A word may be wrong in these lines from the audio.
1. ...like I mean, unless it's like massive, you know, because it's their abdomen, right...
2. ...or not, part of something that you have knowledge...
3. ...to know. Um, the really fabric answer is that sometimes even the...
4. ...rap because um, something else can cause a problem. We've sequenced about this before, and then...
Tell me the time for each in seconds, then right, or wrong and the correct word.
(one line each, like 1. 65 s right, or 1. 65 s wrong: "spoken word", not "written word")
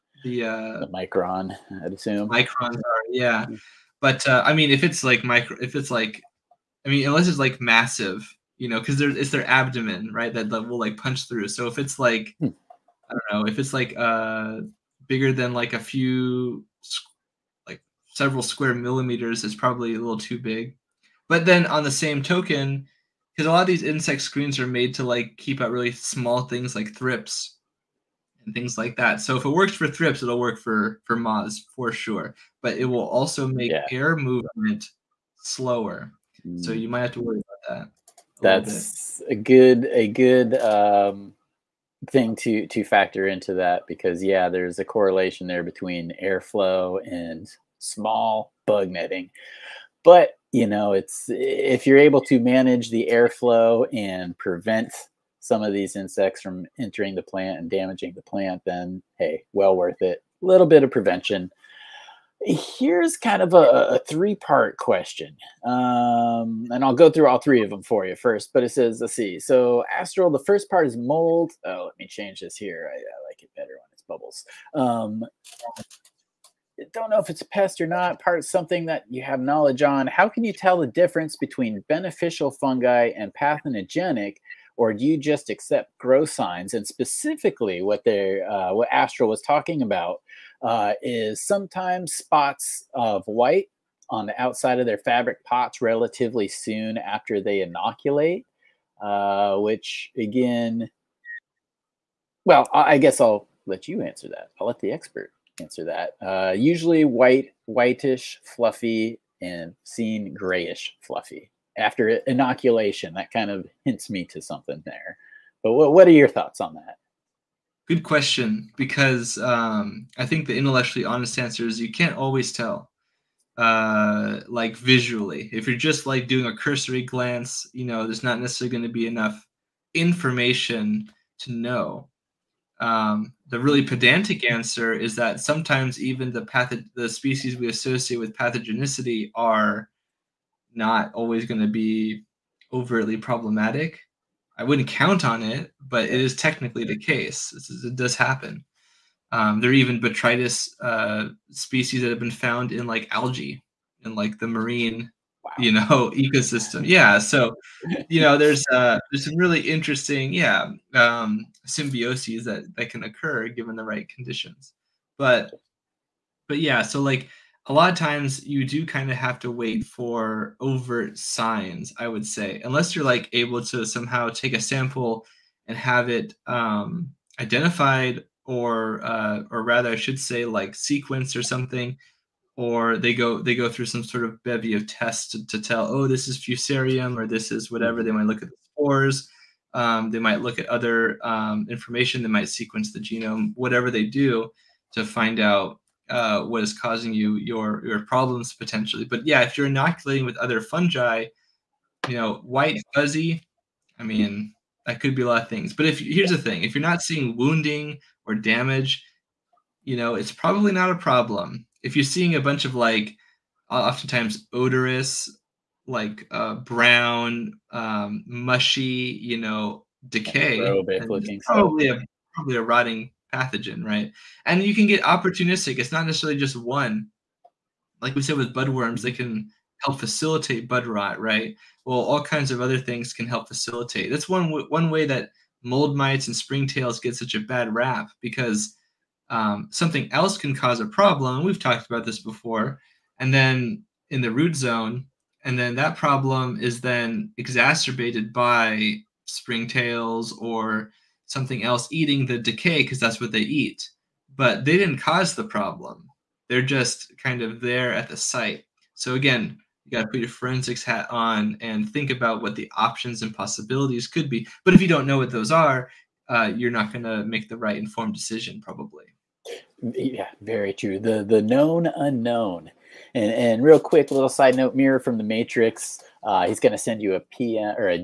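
1. 5 s right
2. 77 s right
3. 131 s wrong: "pedantic", not "fabric"
4. 237 s wrong: "talked", not "sequenced".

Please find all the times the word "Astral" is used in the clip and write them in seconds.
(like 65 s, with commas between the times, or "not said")
69 s, 88 s.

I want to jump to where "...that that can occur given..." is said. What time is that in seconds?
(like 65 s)
162 s.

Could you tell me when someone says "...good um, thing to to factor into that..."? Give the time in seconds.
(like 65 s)
40 s.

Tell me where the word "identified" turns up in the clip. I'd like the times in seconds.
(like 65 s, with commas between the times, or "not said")
177 s.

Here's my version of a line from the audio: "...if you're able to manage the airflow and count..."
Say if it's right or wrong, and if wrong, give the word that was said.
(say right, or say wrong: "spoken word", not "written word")
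wrong: "prevent", not "count".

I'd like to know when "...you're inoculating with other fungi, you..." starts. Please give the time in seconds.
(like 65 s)
199 s.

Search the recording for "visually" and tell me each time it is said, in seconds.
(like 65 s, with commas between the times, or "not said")
124 s.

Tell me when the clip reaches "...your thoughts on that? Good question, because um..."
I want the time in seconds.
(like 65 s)
116 s.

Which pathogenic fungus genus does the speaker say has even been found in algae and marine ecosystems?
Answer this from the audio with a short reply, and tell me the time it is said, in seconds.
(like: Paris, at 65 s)
botrytis, at 149 s.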